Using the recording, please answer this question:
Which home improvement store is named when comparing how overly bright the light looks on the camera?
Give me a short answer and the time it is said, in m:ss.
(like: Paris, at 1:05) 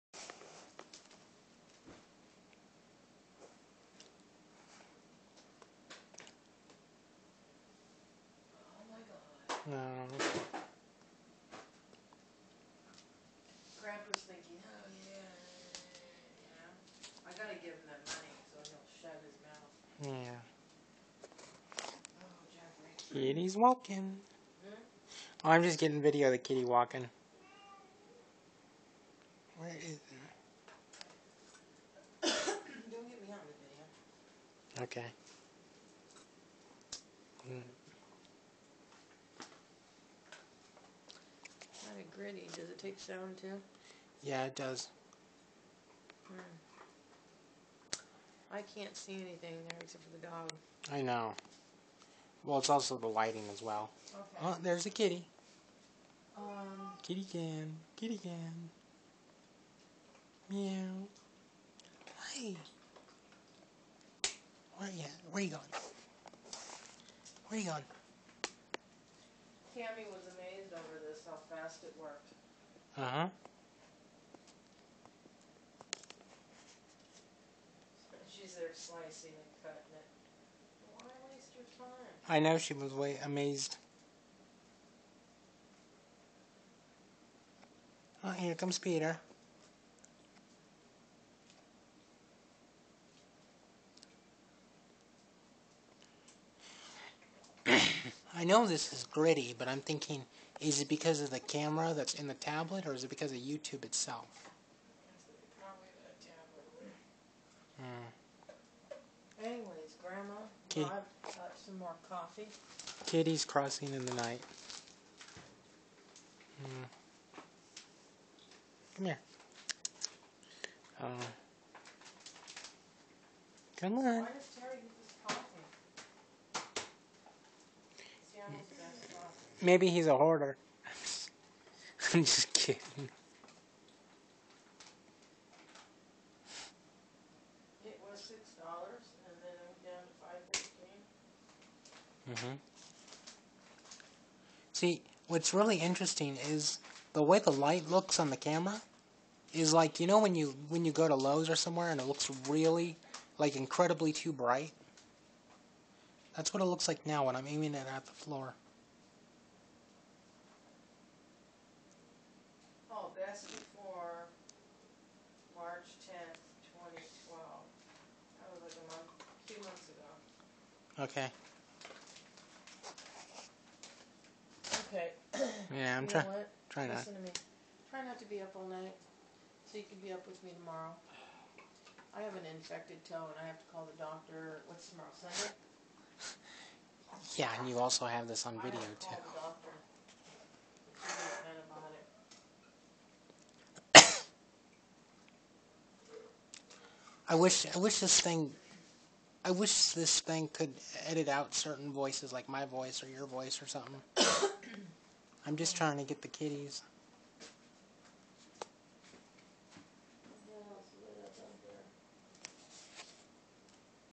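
Lowe's, at 2:31.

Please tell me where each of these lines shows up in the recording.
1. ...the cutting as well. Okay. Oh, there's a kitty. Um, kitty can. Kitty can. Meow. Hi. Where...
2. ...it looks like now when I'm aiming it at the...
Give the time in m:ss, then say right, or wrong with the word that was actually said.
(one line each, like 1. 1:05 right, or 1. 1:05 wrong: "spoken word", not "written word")
1. 0:52 wrong: "lighting", not "cutting"
2. 2:36 right.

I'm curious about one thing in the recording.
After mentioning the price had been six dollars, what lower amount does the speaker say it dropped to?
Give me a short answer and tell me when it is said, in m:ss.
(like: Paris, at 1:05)
$5.15, at 2:20.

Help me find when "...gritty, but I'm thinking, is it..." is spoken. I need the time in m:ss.
1:39.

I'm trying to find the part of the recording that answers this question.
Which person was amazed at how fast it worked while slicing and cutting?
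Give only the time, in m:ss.
1:09.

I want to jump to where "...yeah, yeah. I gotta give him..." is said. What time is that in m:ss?
0:15.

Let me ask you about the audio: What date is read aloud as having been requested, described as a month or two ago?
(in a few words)
March 10, 2012.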